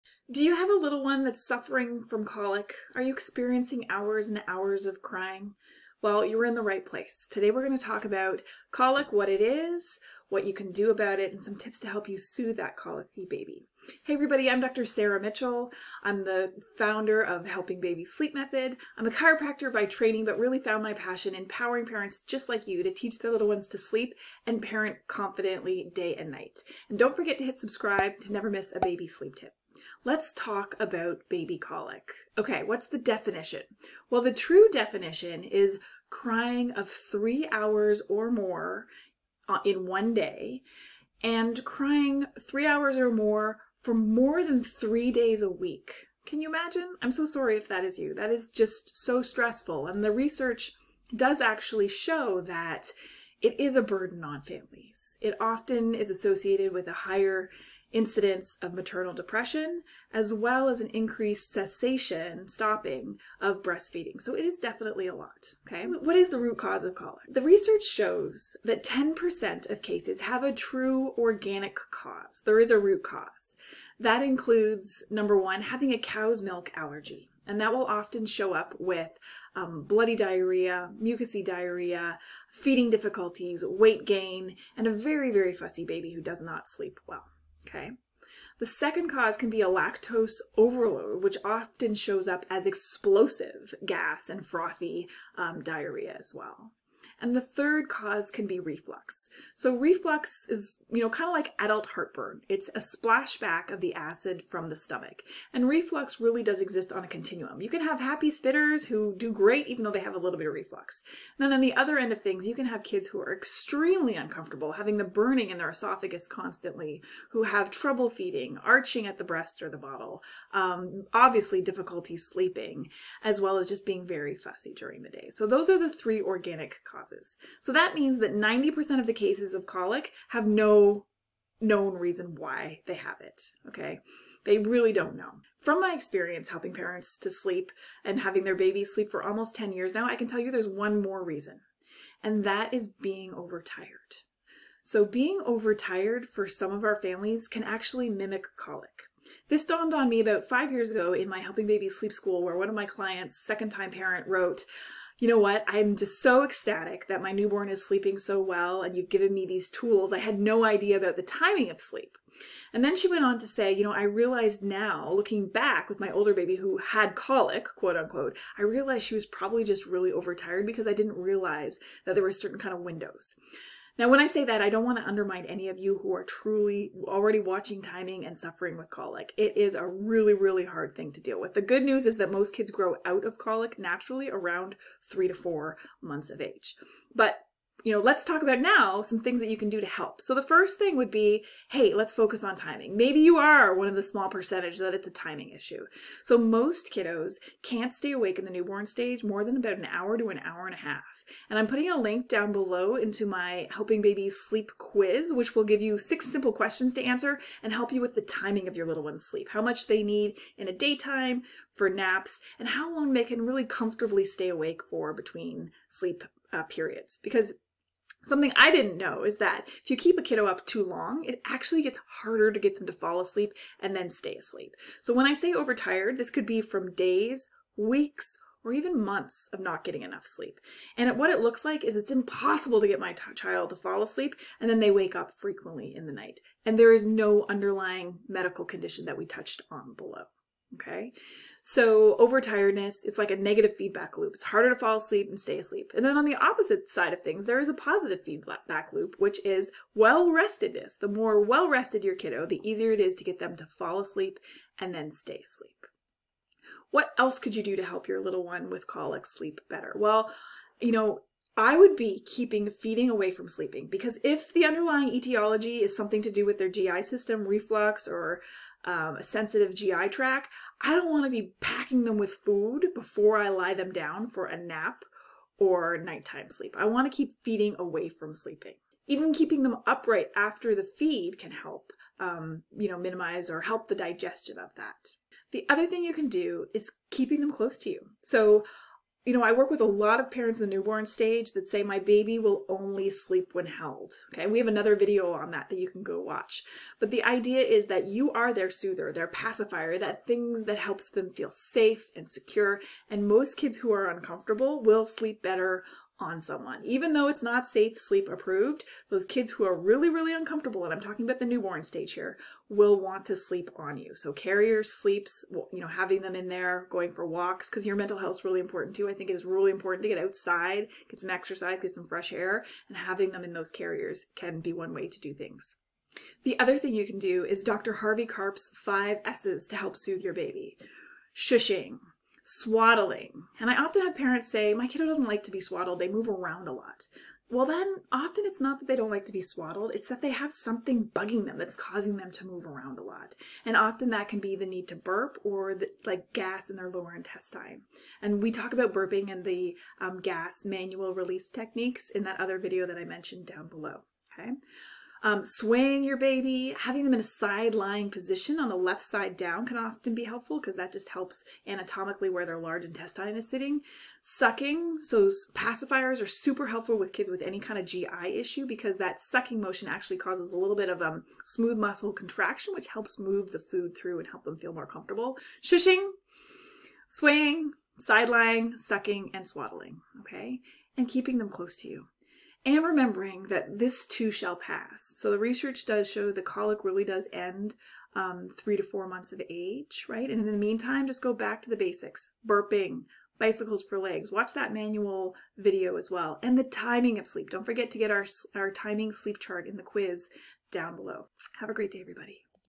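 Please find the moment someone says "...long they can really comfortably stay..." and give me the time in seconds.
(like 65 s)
212 s.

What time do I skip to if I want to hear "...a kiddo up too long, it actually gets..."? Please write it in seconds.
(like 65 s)
220 s.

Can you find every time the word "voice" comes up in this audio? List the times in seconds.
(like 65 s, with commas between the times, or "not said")
not said.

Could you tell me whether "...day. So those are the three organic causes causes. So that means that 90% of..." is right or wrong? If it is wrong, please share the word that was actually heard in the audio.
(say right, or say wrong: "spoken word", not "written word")
right.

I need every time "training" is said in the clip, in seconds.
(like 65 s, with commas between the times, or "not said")
19 s.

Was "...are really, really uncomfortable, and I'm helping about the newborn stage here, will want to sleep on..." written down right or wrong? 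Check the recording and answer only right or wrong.
wrong.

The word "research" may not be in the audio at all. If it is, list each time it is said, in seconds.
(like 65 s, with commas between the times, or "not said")
50 s, 67 s, 385 s.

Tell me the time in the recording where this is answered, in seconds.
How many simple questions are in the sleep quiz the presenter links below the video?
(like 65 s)
205 s.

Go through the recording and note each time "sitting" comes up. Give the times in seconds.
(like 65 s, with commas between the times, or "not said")
363 s.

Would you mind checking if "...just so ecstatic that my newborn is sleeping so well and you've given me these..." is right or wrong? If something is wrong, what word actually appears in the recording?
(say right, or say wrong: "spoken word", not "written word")
right.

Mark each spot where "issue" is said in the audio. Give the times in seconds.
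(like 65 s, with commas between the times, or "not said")
195 s, 368 s.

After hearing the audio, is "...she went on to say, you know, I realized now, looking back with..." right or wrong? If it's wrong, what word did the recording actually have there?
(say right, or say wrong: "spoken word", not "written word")
right.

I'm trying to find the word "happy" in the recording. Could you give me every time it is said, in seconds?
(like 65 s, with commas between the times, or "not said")
107 s.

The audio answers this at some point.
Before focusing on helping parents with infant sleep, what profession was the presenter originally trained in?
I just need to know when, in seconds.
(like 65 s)
19 s.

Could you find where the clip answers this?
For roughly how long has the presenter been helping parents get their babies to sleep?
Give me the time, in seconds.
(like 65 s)
139 s.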